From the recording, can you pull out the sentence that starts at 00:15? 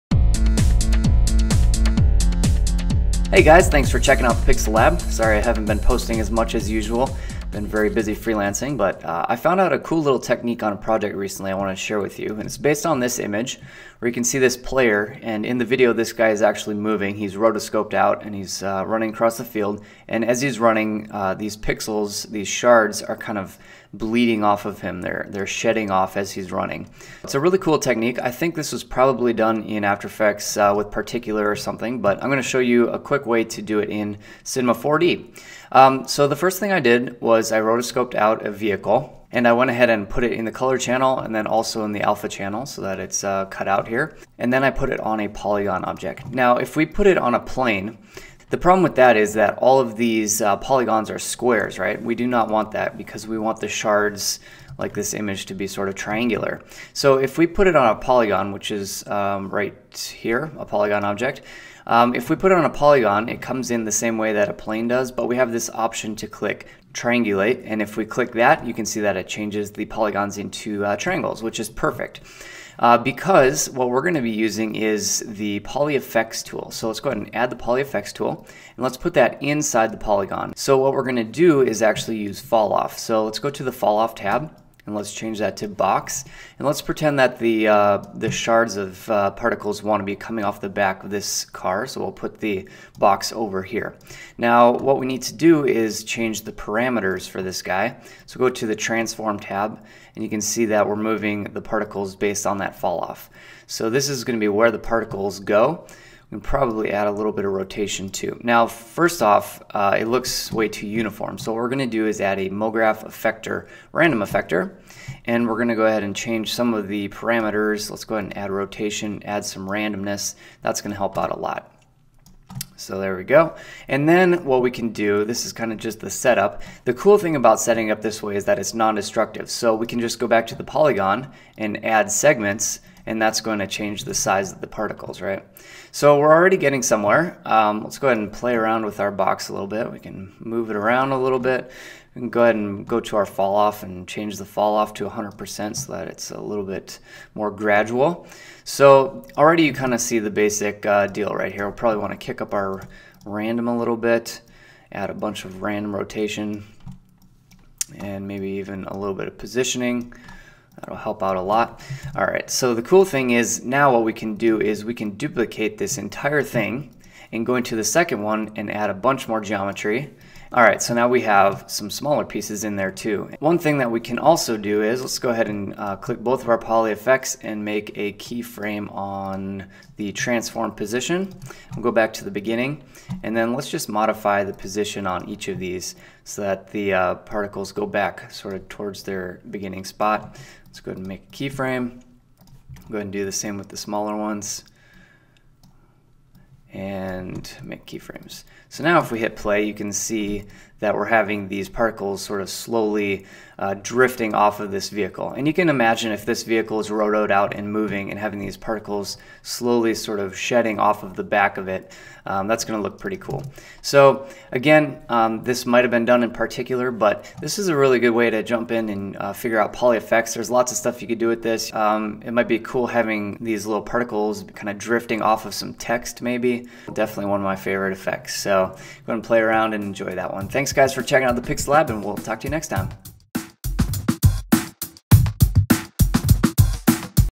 And in the video, this guy is actually moving.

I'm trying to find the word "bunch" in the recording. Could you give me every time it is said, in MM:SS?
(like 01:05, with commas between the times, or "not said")
02:35, 02:48.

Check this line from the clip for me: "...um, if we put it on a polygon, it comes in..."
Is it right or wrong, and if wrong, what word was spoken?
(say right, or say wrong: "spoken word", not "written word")
right.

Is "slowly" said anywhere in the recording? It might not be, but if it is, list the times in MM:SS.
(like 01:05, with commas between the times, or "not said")
03:22, 03:29.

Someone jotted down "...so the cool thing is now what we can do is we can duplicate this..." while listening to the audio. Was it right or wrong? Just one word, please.
right.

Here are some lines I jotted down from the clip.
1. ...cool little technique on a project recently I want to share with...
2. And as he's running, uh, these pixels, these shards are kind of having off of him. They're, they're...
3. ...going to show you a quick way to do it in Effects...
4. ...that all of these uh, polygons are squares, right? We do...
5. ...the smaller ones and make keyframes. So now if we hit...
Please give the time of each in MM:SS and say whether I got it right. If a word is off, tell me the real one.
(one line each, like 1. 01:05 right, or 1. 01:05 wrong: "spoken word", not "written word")
1. 00:09 right
2. 00:20 wrong: "bleeding", not "having"
3. 00:32 wrong: "Cinema", not "Effects"
4. 00:49 right
5. 03:13 right.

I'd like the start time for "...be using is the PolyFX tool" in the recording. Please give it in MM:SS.
01:14.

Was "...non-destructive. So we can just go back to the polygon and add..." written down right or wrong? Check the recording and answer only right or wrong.
right.